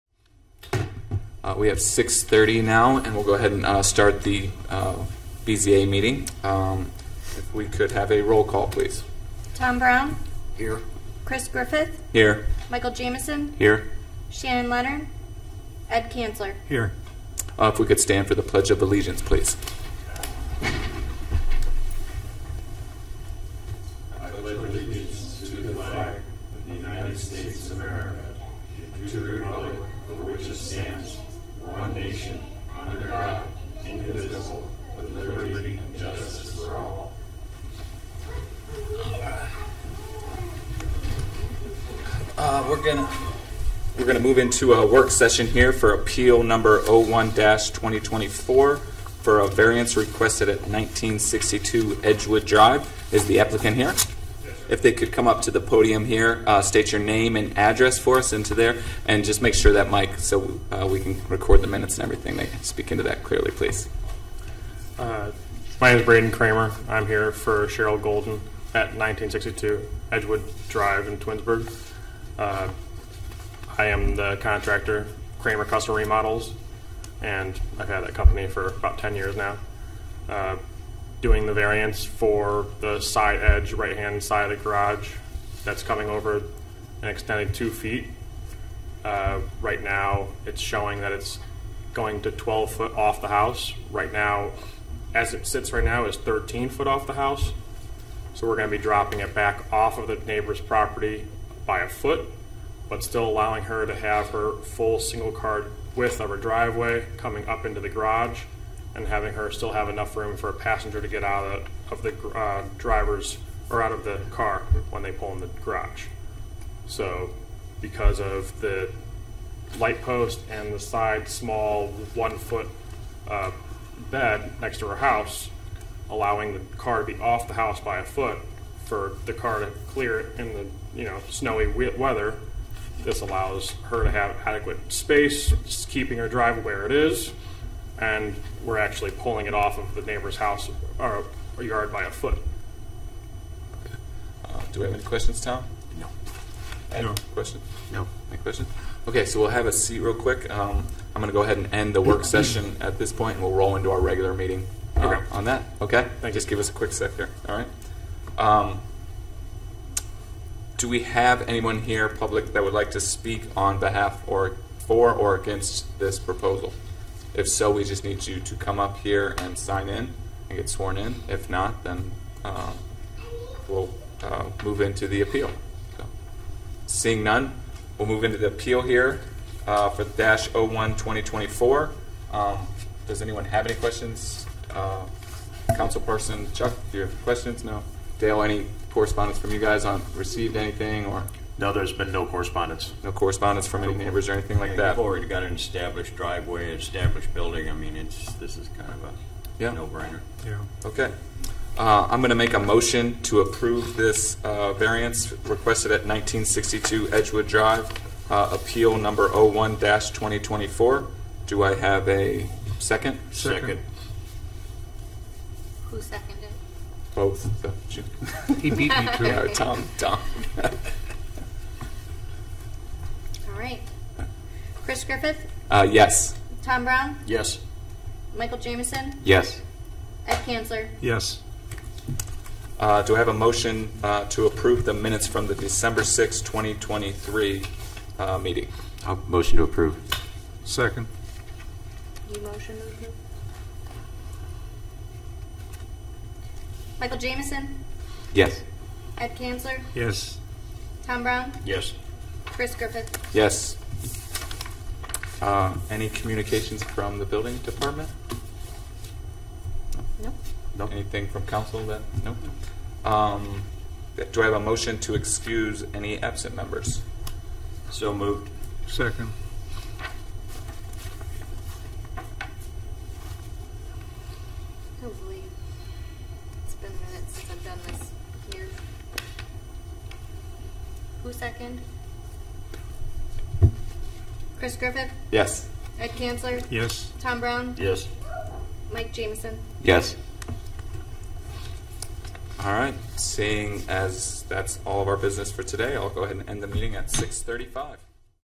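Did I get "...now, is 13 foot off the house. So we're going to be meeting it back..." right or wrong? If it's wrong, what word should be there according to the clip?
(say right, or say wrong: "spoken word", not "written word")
wrong: "dropping", not "meeting".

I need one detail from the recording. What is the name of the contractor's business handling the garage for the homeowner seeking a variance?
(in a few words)
Kramer Custom Remodels.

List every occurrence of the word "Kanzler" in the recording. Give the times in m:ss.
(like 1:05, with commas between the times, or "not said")
0:16, 3:50, 4:09, 4:46.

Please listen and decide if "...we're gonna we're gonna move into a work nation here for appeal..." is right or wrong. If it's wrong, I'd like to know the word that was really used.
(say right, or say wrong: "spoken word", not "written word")
wrong: "session", not "nation".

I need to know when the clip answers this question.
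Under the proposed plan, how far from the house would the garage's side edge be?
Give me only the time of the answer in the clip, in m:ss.
1:32.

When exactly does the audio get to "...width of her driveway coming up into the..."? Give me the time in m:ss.
1:45.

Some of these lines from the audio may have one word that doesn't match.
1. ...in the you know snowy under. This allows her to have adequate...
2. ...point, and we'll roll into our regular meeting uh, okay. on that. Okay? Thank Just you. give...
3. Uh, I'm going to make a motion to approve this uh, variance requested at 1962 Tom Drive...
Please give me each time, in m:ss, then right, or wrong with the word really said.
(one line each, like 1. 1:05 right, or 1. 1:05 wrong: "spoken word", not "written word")
1. 2:10 wrong: "weather", not "under"
2. 2:33 right
3. 3:21 wrong: "Edgewood", not "Tom".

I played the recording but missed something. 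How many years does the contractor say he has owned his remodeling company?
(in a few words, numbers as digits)
10 years.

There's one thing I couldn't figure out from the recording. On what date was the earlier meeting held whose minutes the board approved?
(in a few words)
December 6, 2023.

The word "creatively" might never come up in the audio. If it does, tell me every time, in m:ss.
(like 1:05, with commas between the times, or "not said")
not said.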